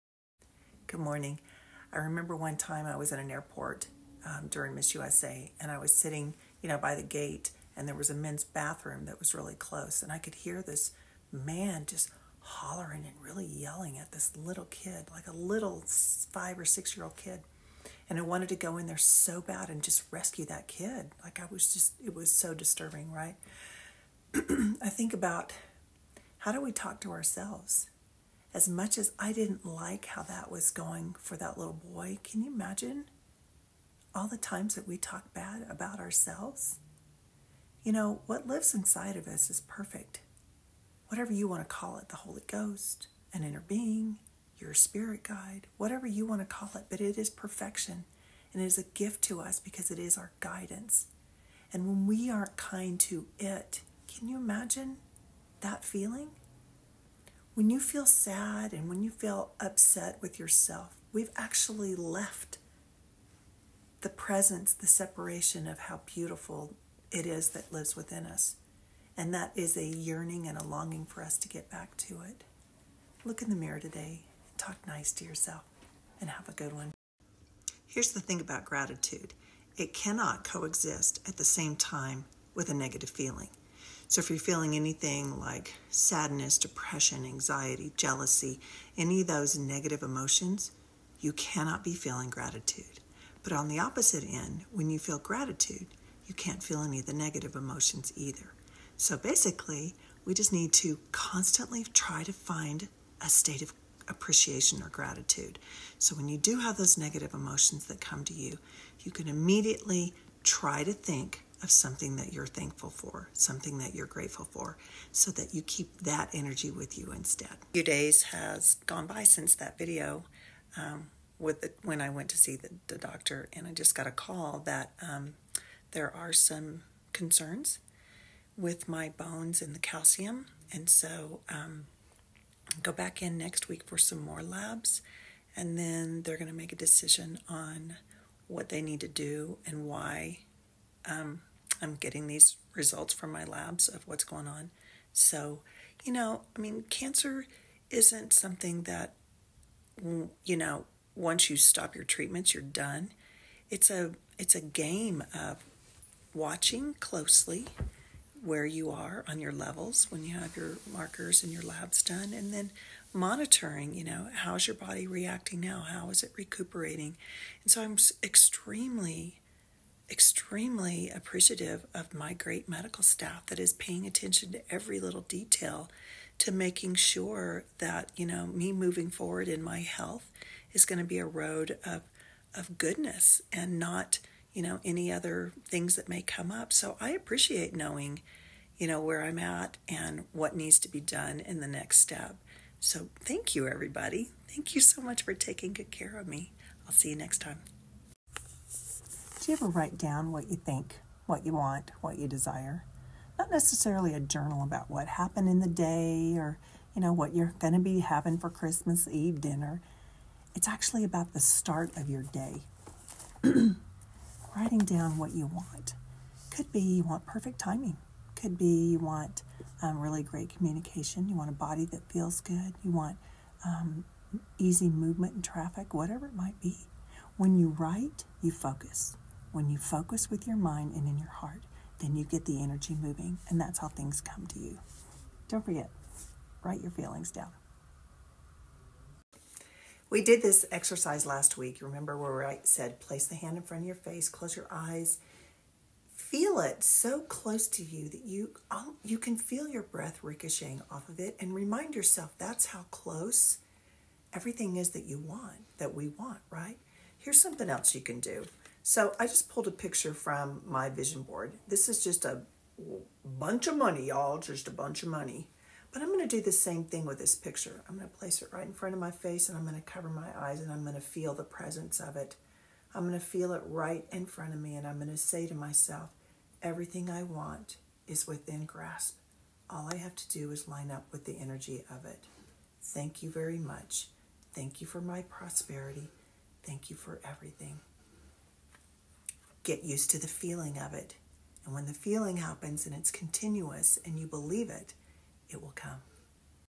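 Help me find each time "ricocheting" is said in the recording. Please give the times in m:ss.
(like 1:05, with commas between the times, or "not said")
4:10.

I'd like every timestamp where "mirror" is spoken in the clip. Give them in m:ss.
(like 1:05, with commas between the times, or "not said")
1:13.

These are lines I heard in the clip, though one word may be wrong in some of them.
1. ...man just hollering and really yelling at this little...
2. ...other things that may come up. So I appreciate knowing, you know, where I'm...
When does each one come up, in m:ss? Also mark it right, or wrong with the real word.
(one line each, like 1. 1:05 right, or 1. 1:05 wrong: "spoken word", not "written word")
1. 0:11 right
2. 3:05 right.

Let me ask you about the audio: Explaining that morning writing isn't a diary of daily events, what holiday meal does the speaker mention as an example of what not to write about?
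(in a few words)
Christmas Eve dinner.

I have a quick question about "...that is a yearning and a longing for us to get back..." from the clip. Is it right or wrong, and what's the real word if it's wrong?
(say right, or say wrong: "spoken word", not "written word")
right.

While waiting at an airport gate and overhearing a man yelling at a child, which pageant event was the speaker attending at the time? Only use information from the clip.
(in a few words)
Miss USA.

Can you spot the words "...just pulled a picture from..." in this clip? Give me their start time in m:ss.
4:19.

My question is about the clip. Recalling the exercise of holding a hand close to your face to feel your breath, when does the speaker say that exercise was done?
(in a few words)
Last week.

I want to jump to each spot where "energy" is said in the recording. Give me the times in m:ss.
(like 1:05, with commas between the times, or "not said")
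1:56, 3:52, 4:41.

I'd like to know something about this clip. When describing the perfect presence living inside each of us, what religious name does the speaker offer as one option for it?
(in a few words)
Holy Ghost.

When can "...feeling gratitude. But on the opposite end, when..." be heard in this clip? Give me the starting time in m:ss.
1:31.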